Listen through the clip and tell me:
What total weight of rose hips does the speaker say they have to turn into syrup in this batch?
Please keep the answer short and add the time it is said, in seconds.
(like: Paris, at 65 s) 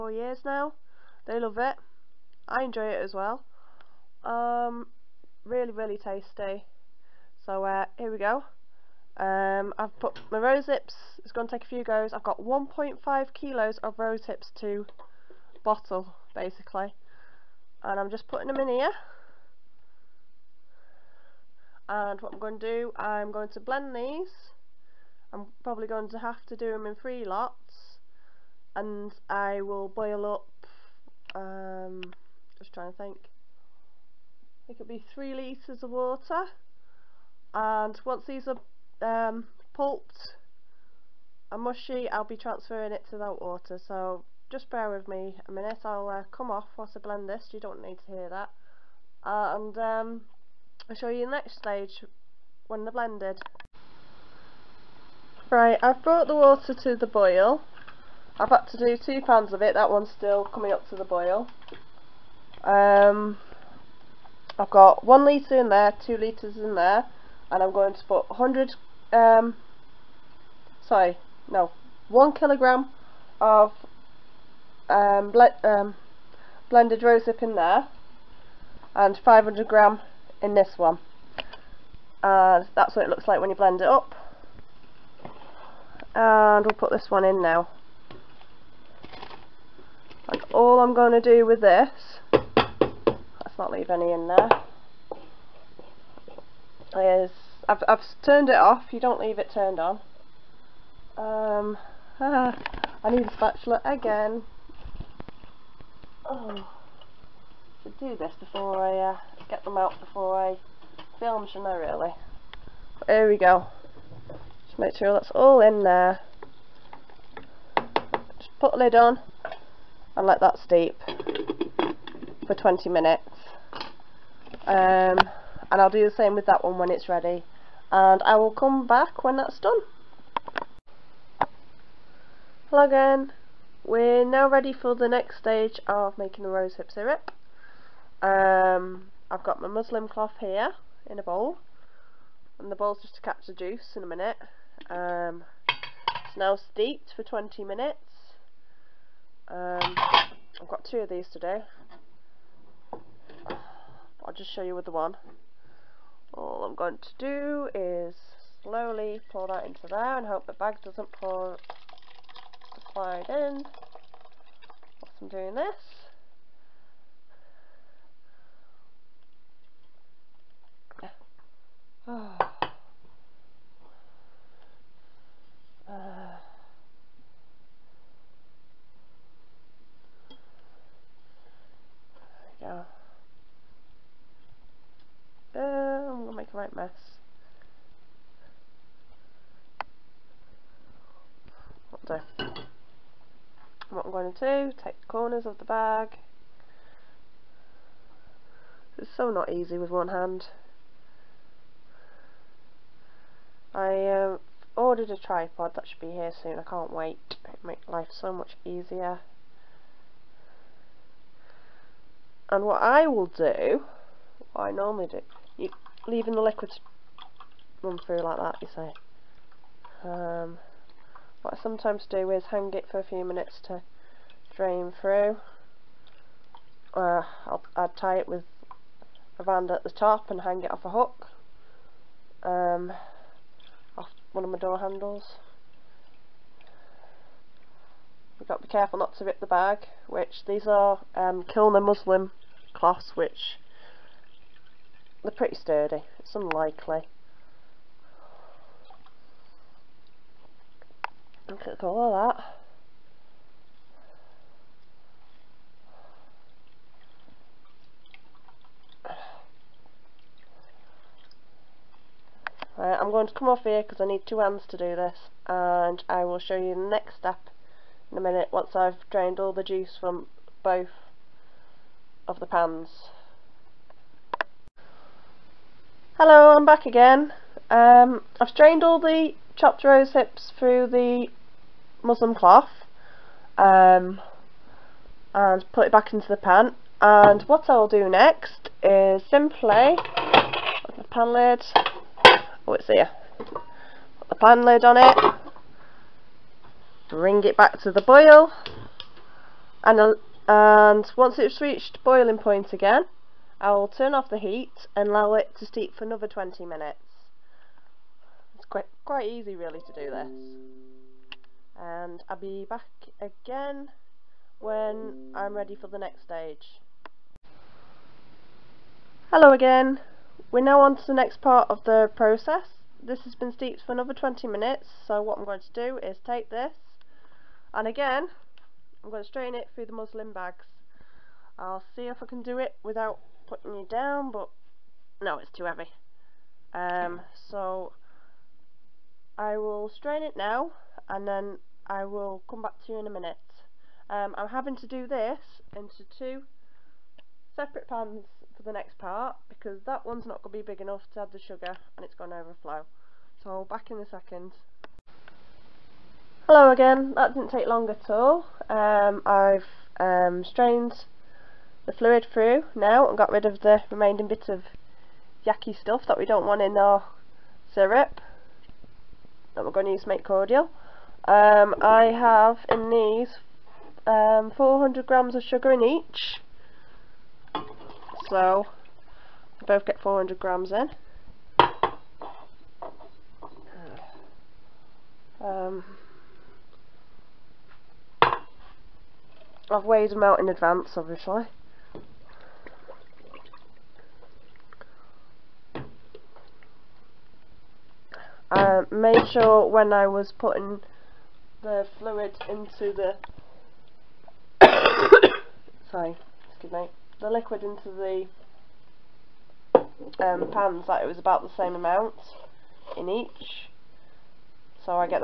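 1.5 kilos, at 12 s.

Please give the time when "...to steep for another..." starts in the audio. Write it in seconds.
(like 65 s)
305 s.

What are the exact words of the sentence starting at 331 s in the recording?
I'll see if I can do it without putting you down, but no, it's too heavy.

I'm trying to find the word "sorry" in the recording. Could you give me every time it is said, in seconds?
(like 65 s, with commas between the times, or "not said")
70 s, 405 s.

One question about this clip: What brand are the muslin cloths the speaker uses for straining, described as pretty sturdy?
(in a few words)
Kilner.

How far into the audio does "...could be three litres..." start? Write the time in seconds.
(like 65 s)
34 s.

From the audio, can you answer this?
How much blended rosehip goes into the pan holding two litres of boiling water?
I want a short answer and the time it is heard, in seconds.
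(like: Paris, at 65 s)
1 kilogram, at 72 s.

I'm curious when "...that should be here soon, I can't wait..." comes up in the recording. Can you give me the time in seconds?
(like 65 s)
205 s.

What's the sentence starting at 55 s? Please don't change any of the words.
Right, I've brought the water to the boil.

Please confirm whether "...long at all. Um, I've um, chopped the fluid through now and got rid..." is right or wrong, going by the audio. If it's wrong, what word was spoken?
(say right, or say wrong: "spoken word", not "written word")
wrong: "strained", not "chopped".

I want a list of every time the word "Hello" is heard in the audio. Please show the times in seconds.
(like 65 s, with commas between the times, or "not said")
132 s, 276 s, 319 s, 356 s.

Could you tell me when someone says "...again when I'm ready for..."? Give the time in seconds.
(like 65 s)
313 s.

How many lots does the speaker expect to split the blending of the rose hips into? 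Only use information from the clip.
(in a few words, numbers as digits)
3.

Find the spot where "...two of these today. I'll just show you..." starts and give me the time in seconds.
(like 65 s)
150 s.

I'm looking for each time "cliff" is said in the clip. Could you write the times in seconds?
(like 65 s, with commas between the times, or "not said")
not said.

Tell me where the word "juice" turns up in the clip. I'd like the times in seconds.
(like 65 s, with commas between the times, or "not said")
143 s, 269 s.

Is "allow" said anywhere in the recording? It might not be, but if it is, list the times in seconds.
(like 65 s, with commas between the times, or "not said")
305 s.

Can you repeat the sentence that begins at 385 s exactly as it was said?
Um, I've weighed them out in advance, obviously.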